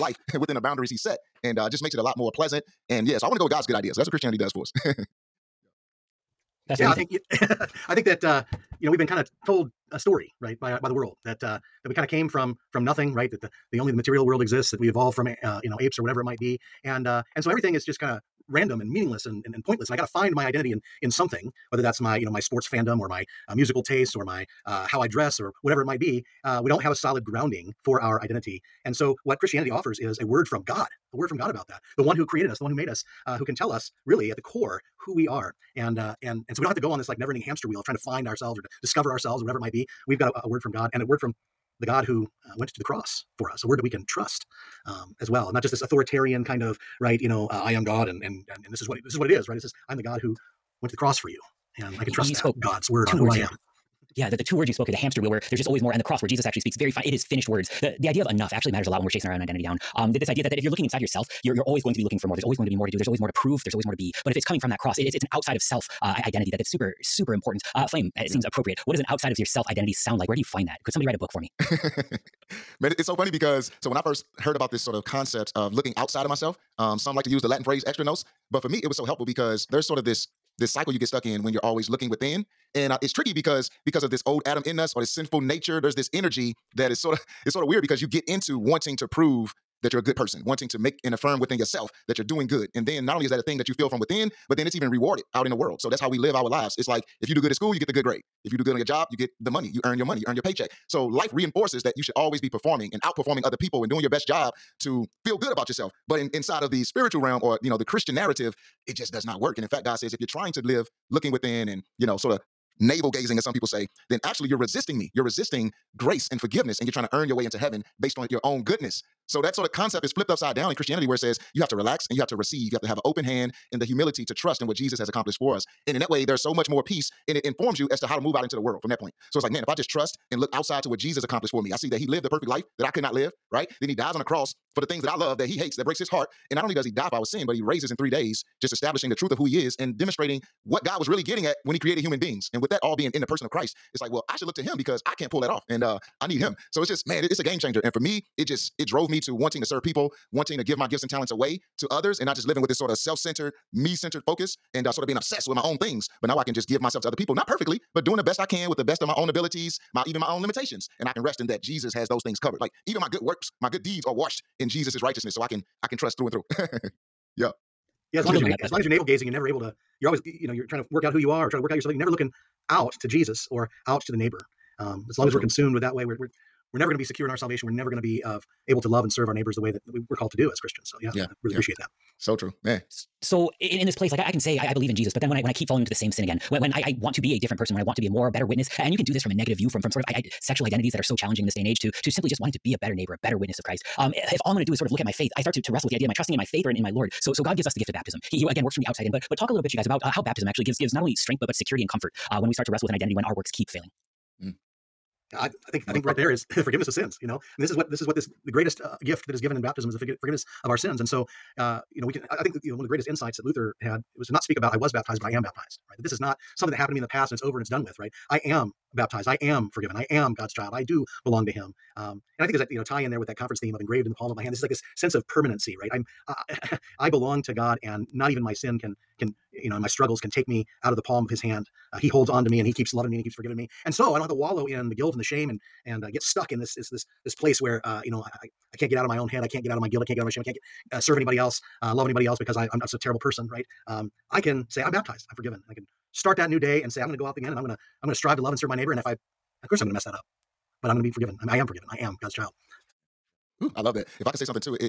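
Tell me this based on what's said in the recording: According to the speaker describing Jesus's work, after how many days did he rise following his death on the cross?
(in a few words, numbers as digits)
3 days.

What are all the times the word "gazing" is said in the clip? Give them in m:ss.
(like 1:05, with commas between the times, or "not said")
1:53, 2:49.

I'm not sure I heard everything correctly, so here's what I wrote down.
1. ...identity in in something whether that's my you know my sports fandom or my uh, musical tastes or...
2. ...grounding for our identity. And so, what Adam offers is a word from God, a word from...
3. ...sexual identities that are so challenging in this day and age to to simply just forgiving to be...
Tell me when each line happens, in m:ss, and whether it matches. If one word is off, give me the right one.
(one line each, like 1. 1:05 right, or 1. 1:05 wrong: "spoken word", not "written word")
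1. 0:20 right
2. 0:27 wrong: "Christianity", not "Adam"
3. 3:10 wrong: "wanting", not "forgiving".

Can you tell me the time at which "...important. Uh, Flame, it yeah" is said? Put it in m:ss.
1:07.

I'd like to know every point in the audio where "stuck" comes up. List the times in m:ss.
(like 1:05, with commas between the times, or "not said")
1:21, 3:56.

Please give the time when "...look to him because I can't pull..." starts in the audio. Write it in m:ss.
2:24.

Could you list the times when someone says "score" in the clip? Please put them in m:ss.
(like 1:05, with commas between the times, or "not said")
not said.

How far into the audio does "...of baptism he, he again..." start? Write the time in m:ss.
3:17.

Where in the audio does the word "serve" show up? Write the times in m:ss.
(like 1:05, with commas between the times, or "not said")
2:29, 2:59, 4:00, 4:08.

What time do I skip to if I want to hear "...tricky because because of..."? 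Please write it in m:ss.
1:23.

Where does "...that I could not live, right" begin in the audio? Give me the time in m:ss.
2:12.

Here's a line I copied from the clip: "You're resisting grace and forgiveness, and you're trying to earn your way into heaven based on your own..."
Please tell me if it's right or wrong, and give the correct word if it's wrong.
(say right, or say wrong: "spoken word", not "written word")
right.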